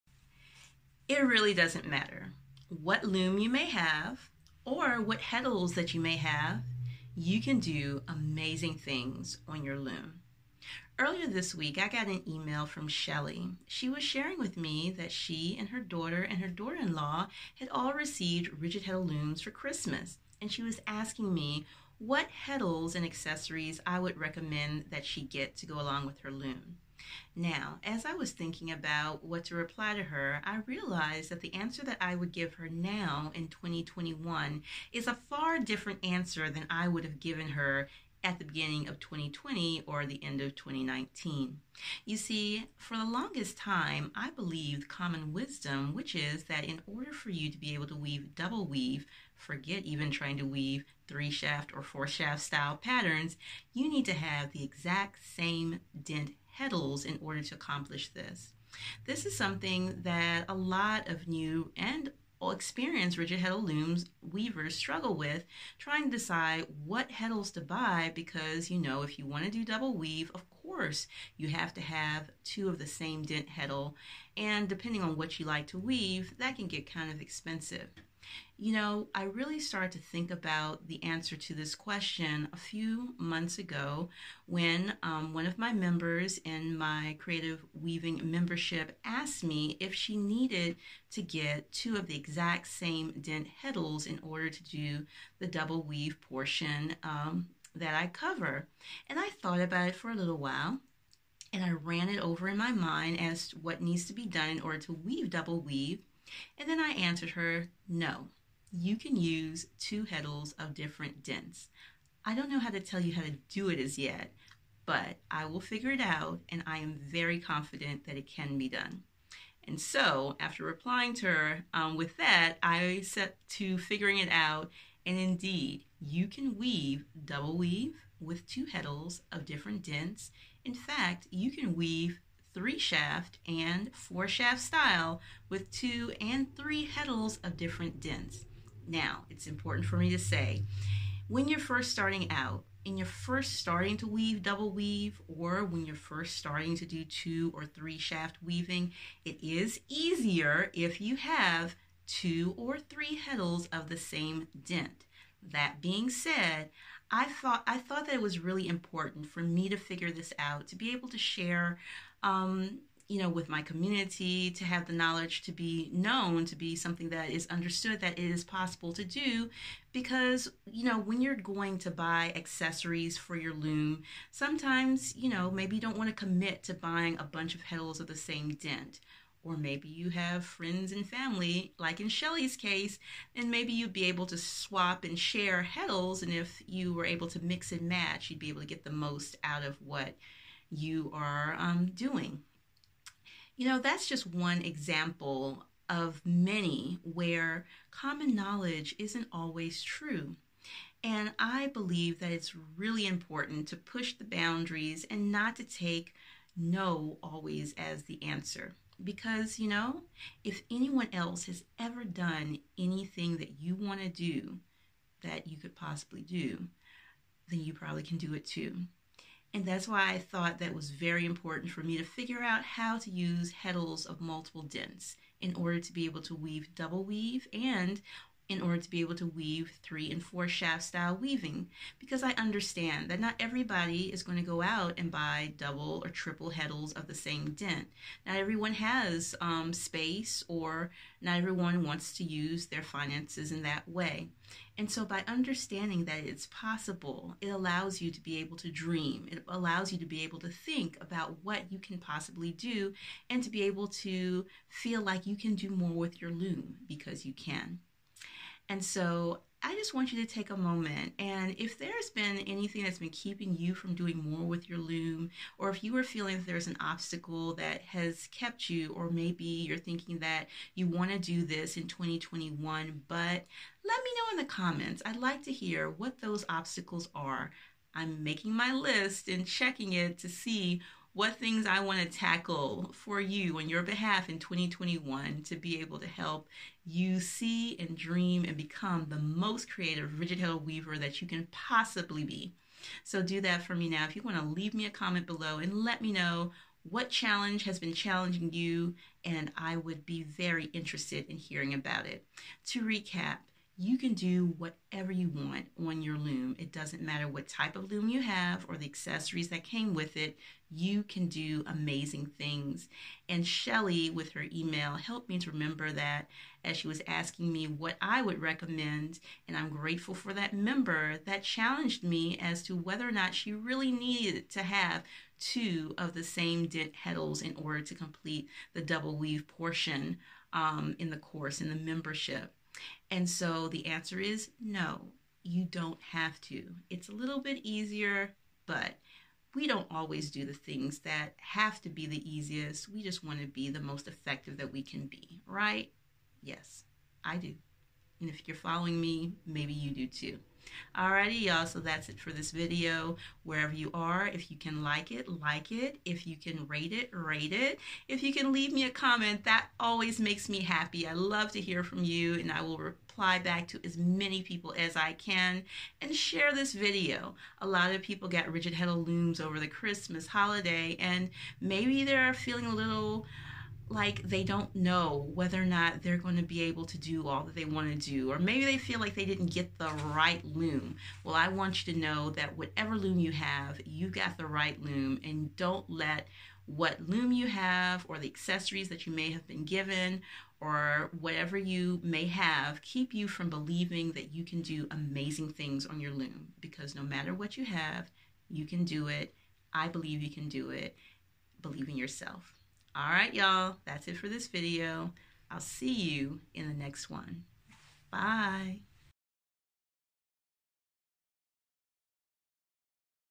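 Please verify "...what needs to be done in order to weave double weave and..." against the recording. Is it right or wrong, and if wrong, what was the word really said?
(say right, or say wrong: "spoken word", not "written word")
right.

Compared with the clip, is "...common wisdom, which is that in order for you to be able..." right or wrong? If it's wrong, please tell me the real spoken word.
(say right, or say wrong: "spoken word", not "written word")
right.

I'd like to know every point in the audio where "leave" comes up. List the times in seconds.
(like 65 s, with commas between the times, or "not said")
294 s, 358 s.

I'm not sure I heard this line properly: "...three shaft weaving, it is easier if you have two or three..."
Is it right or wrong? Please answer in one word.
right.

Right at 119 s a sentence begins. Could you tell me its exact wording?
And so, after replying to her um, with that, I set to figuring it out.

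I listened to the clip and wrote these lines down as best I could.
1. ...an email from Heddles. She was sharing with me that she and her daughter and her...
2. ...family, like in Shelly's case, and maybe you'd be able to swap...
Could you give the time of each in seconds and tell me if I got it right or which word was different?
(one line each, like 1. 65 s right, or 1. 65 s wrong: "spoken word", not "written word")
1. 12 s wrong: "Shelly", not "Heddles"
2. 181 s right.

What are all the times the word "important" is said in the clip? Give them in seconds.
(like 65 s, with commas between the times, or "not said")
139 s, 158 s, 203 s, 221 s.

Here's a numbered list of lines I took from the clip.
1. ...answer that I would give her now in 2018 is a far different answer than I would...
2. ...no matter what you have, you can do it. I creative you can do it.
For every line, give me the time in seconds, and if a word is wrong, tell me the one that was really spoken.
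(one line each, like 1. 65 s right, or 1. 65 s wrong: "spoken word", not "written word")
1. 31 s wrong: "2021", not "2018"
2. 396 s wrong: "believe", not "creative".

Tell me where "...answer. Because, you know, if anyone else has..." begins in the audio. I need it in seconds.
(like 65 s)
208 s.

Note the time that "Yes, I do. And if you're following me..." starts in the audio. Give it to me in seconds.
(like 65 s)
346 s.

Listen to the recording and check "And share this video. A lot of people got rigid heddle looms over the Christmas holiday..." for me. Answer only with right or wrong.
right.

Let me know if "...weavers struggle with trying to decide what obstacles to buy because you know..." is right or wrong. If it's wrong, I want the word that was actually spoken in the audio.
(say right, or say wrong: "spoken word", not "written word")
wrong: "heddles", not "obstacles".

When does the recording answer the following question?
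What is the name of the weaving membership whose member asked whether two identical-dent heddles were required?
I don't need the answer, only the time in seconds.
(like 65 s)
87 s.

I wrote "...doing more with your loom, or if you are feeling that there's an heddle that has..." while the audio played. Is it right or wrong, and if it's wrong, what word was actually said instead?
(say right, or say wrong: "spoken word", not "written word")
wrong: "obstacle", not "heddle".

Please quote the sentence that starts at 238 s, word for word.
Not everyone has um, space or not everyone wants to use their finances in that way.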